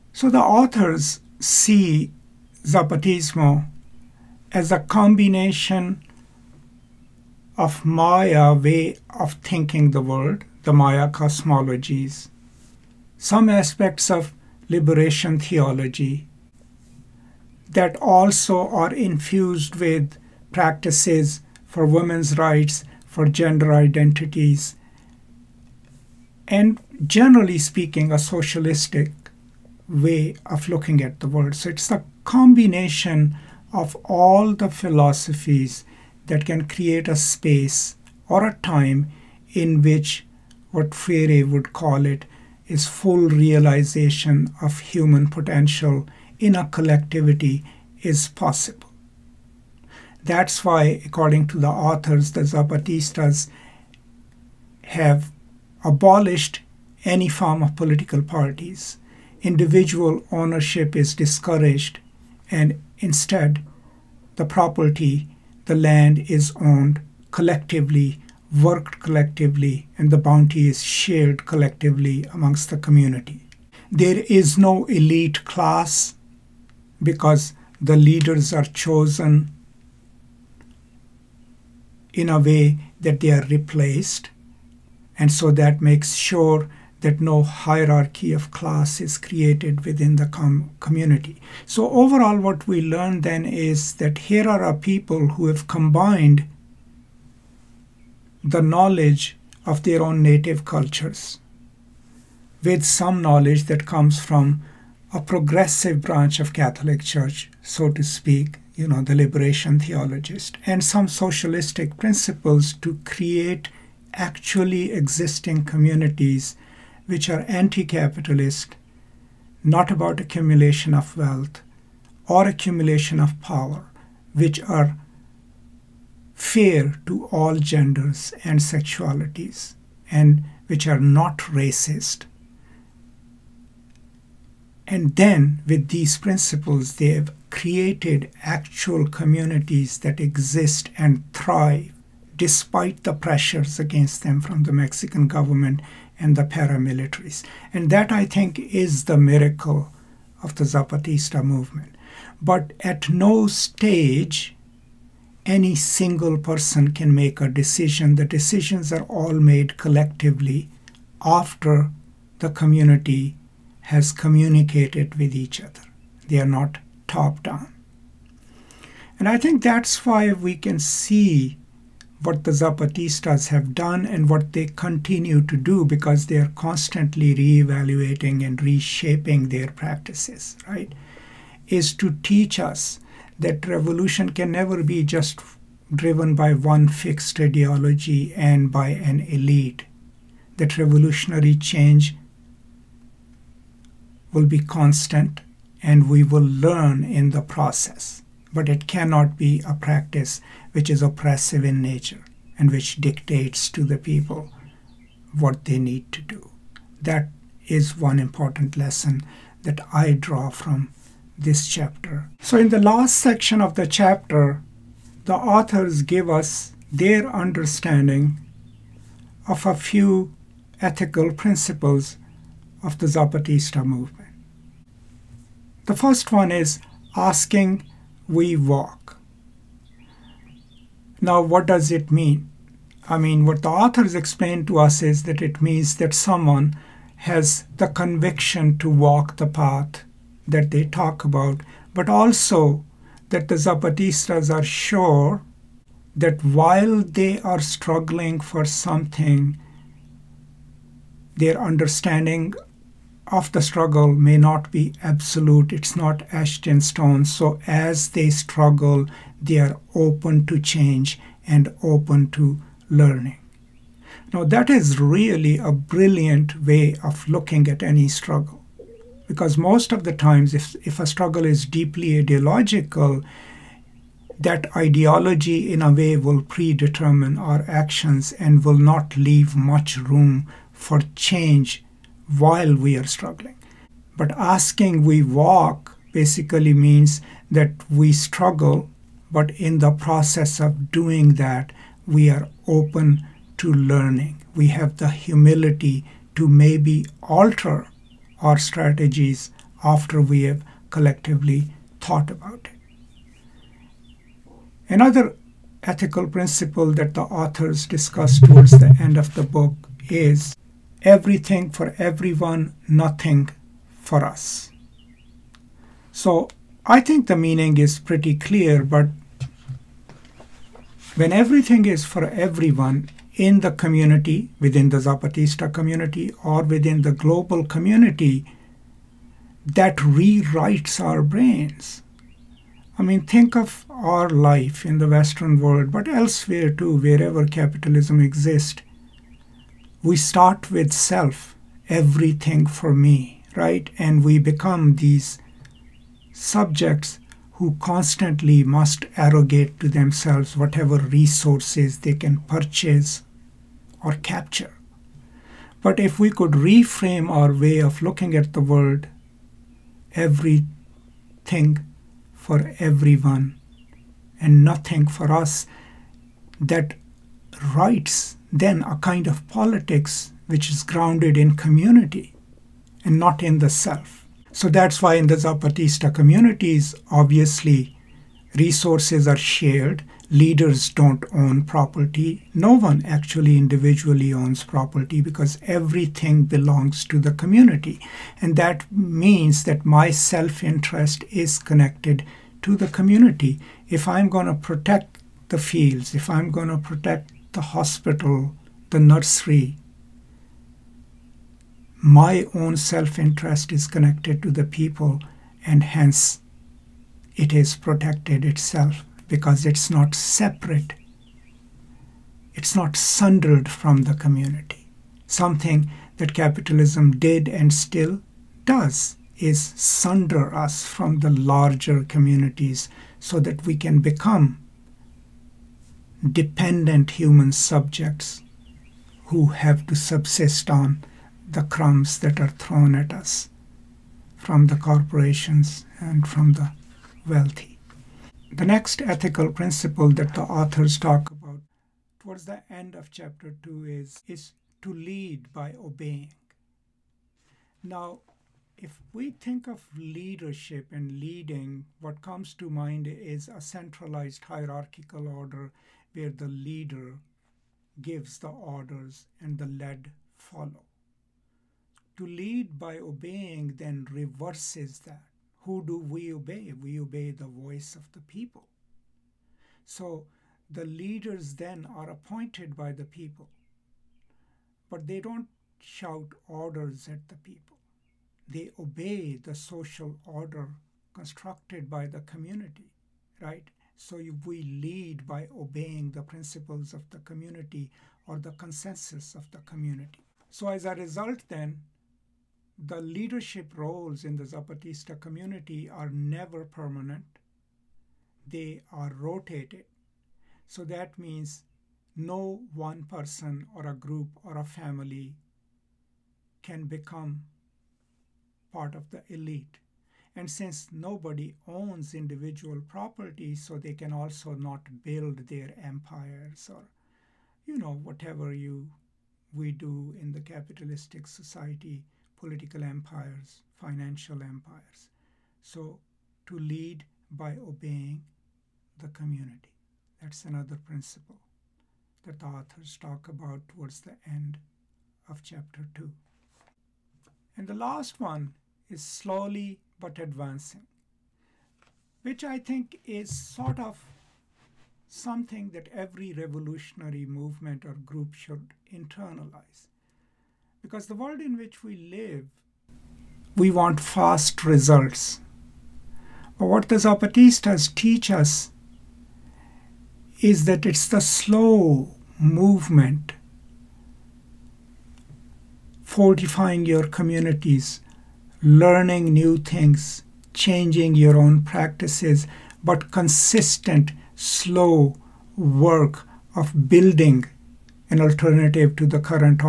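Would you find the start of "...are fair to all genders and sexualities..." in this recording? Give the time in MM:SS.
02:04.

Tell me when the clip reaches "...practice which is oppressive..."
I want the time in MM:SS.
03:19.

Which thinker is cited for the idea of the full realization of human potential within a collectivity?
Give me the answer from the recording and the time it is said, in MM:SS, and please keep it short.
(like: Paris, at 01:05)
Freire, at 00:40.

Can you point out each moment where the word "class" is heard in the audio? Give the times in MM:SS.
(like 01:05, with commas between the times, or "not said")
01:15, 01:28.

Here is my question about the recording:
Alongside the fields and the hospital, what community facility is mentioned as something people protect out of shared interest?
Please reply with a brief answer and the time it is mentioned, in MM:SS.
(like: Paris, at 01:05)
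The nursery, at 06:38.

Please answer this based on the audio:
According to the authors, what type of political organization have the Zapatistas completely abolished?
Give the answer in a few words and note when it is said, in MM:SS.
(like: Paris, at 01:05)
Political parties, at 00:57.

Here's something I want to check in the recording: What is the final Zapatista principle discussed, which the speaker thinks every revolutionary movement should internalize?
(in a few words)
Slowly but advancing.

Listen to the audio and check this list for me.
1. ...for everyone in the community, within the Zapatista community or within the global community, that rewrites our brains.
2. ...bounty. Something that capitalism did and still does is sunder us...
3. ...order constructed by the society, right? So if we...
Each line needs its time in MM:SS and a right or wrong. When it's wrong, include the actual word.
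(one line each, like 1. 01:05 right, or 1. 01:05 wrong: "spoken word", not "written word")
1. 05:22 right
2. 06:54 wrong: "community", not "bounty"
3. 08:00 wrong: "community", not "society".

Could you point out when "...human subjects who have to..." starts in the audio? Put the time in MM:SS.
07:07.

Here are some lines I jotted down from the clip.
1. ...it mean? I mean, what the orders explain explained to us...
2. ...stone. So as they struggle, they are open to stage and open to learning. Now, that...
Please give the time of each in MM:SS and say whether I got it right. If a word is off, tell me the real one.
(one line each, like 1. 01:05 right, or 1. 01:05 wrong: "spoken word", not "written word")
1. 03:51 wrong: "authors", not "orders"
2. 04:16 wrong: "change", not "stage".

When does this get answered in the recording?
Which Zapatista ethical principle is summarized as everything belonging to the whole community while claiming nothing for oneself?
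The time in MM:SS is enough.
05:11.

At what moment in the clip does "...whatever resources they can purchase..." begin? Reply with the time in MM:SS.
05:50.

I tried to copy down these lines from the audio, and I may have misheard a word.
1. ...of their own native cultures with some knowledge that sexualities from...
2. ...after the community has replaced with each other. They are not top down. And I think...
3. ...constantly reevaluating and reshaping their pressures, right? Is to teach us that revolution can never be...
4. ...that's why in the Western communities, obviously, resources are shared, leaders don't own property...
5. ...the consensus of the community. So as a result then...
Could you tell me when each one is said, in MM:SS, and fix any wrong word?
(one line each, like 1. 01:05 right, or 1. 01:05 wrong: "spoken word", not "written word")
1. 01:39 wrong: "comes", not "sexualities"
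2. 02:41 wrong: "communicated", not "replaced"
3. 02:56 wrong: "practices", not "pressures"
4. 06:14 wrong: "Zapatista", not "Western"
5. 08:08 right.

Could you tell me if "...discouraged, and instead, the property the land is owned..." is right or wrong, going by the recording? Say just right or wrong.
right.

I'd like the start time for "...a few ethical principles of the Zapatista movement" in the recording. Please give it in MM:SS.
03:39.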